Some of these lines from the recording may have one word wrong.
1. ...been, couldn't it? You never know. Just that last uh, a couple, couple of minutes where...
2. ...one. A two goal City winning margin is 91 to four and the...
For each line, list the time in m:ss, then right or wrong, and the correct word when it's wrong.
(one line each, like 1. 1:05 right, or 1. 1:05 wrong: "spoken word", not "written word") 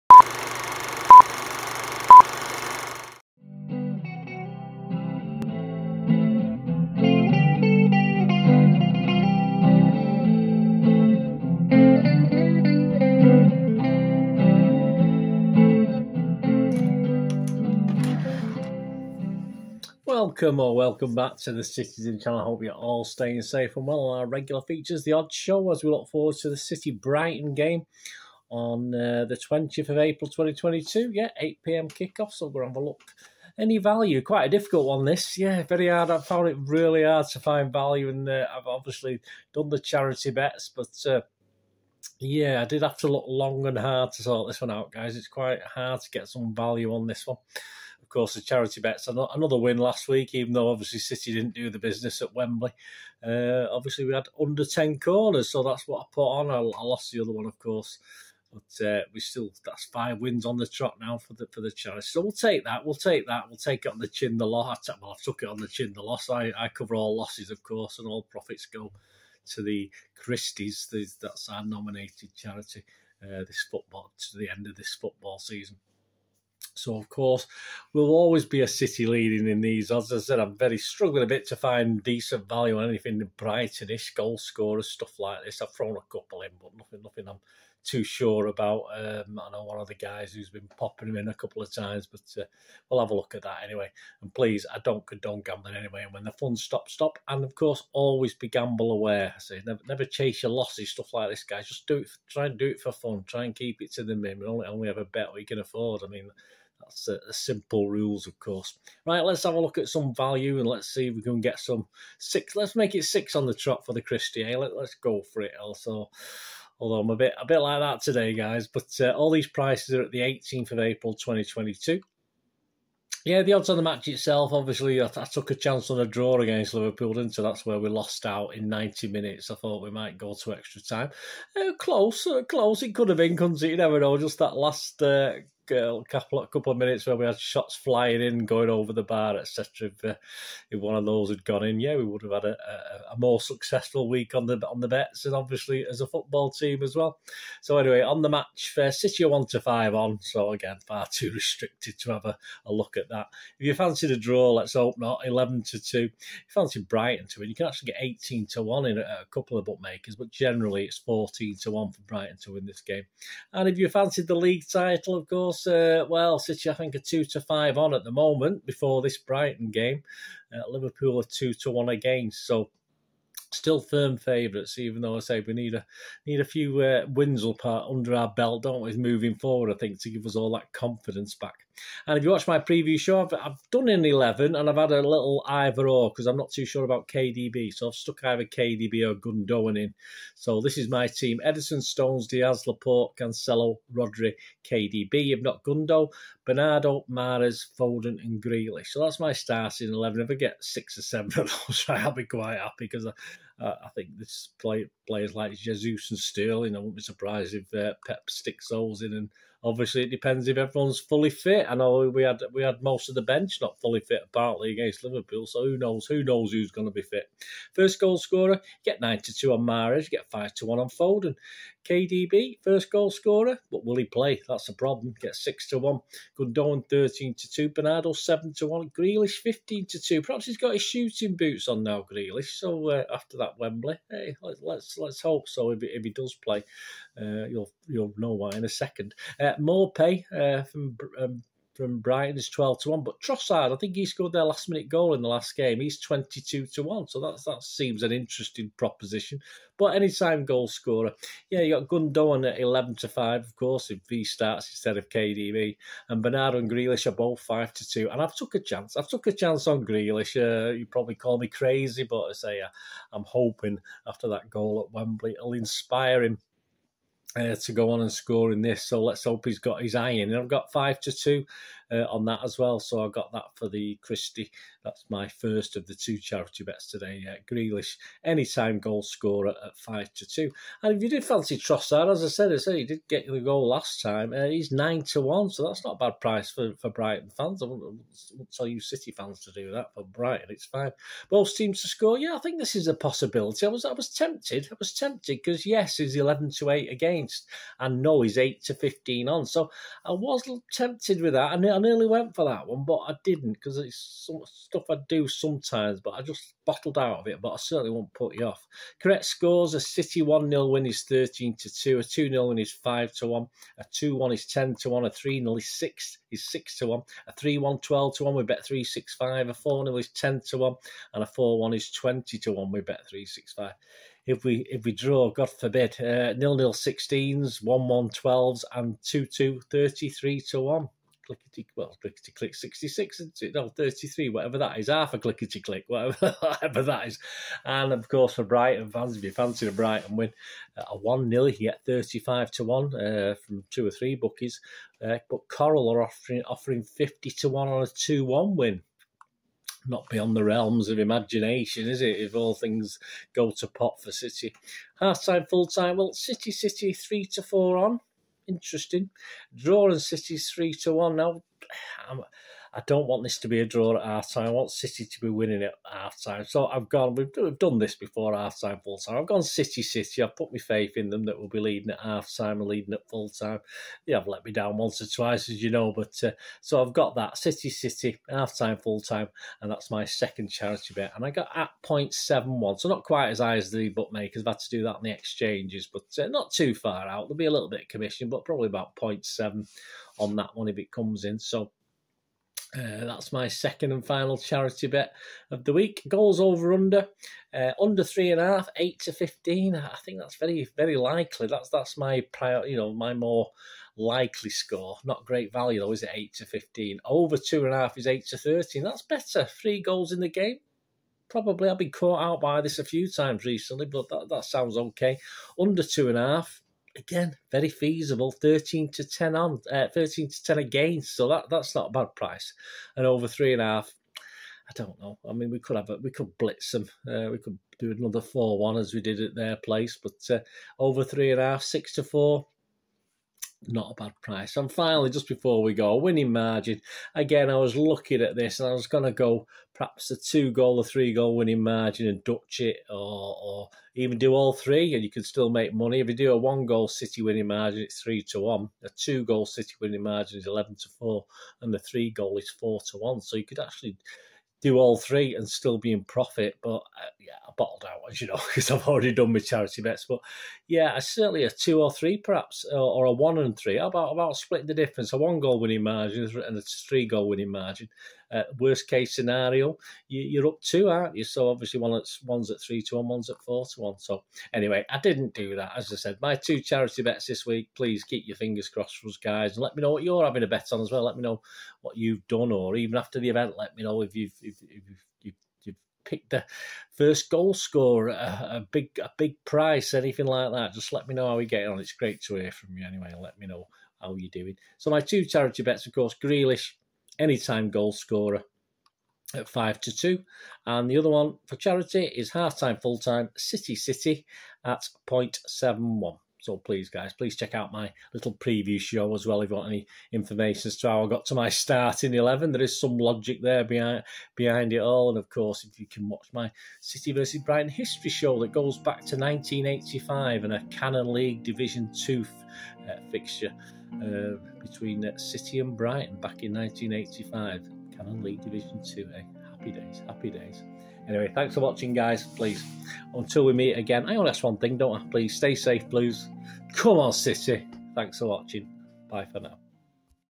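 1. 2:13 right
2. 7:28 wrong: "11", not "91".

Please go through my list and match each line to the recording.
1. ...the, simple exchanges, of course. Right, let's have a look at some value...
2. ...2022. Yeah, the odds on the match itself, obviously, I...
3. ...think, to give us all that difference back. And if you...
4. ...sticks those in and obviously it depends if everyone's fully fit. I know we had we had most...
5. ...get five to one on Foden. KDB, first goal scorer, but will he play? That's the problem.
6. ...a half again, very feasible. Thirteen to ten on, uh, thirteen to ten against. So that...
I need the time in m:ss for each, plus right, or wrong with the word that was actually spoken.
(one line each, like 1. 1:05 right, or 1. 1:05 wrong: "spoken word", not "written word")
1. 1:47 wrong: "rules", not "exchanges"
2. 2:01 right
3. 2:59 wrong: "confidence", not "difference"
4. 3:28 right
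5. 3:40 right
6. 6:56 right.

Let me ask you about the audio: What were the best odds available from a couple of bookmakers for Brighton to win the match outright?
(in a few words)
18 to 1.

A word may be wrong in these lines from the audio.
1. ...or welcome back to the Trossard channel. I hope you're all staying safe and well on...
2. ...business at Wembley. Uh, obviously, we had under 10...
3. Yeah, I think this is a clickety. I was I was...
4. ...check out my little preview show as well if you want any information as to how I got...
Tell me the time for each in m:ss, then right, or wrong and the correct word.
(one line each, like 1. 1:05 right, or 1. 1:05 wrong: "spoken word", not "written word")
1. 0:20 wrong: "Citizen", not "Trossard"
2. 0:51 right
3. 4:52 wrong: "possibility", not "clickety"
4. 8:27 right.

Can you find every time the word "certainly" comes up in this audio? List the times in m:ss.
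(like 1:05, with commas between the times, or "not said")
5:07, 7:40.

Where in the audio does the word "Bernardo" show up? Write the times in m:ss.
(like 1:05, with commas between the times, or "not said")
3:16, 3:47, 4:16.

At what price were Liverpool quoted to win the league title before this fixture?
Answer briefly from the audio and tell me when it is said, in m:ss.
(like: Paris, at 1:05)
2 to 1, at 2:51.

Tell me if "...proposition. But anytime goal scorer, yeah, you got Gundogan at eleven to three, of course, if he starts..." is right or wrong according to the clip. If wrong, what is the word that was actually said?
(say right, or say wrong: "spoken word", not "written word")
wrong: "five", not "three".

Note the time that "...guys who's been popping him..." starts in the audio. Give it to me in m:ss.
1:29.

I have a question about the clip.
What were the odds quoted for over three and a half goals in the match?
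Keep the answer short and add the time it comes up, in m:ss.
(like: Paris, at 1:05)
6 to 4, at 7:11.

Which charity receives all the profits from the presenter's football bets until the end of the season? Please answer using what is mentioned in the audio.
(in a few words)
Christies.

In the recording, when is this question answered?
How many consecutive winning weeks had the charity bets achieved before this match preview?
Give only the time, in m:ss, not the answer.
0:59.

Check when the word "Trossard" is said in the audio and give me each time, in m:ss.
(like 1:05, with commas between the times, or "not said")
4:03, 4:41.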